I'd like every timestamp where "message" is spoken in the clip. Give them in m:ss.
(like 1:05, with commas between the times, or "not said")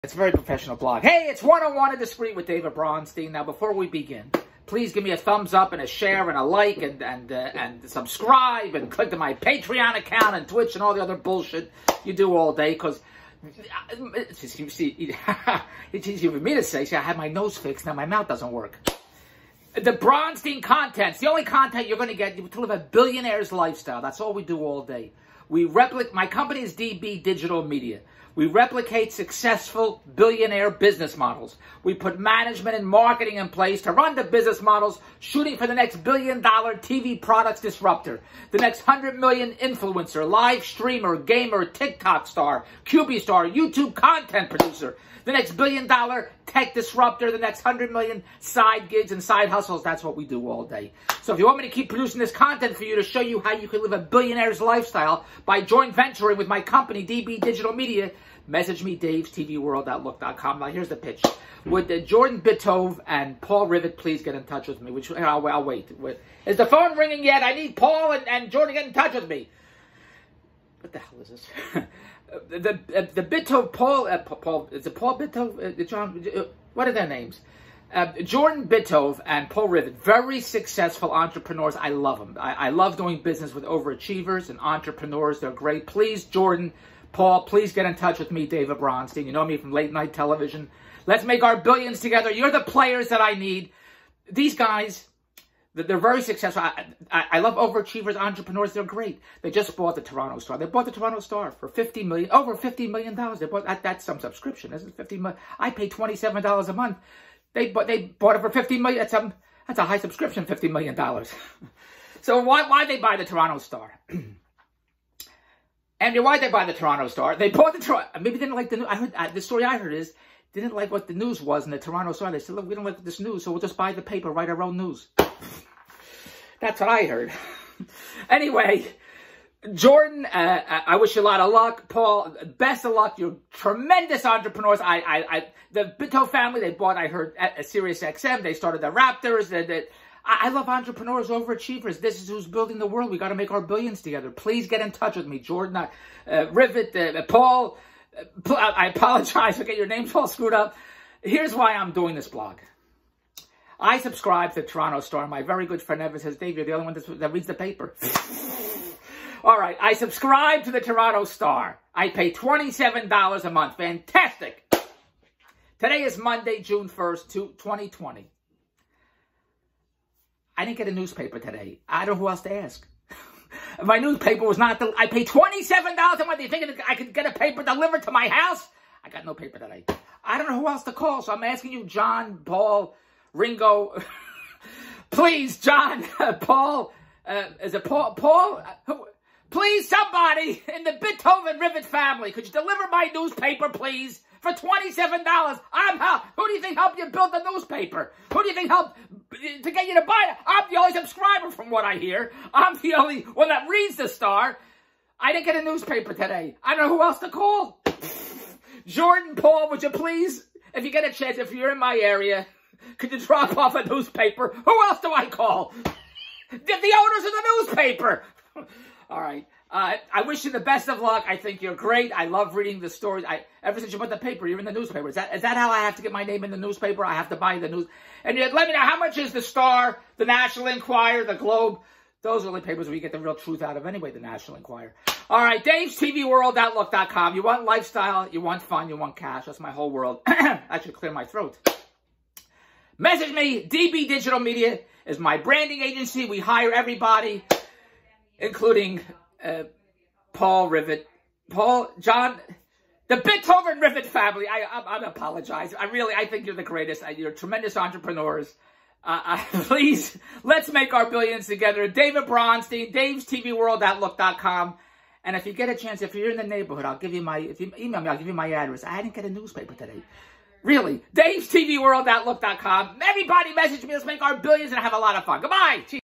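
0:58, 4:02, 4:33.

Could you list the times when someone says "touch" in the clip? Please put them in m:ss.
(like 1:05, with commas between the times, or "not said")
1:04, 1:08, 1:27, 2:24.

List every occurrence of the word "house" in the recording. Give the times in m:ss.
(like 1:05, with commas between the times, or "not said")
2:58.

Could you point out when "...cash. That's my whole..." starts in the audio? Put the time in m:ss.
3:59.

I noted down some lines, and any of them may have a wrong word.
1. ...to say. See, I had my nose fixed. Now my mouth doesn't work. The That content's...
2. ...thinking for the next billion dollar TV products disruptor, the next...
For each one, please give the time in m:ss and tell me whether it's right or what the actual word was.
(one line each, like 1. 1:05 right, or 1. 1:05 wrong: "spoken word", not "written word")
1. 0:16 wrong: "Bronstein", not "That"
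2. 0:35 wrong: "shooting", not "thinking".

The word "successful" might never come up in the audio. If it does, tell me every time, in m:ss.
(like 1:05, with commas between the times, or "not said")
0:29, 1:20, 1:36.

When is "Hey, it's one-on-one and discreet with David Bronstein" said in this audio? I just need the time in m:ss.
0:01.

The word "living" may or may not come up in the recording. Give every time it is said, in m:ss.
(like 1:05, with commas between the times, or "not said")
not said.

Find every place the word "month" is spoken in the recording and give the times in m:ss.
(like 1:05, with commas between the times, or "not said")
1:46, 2:43, 2:56.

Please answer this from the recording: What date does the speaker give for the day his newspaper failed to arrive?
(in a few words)
Monday, June 1st, 2020.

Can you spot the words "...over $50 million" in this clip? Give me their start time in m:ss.
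1:42.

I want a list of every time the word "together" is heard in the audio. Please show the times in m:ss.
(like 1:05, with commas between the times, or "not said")
1:31, 2:24, 4:21.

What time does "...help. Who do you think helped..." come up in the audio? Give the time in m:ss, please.
3:15.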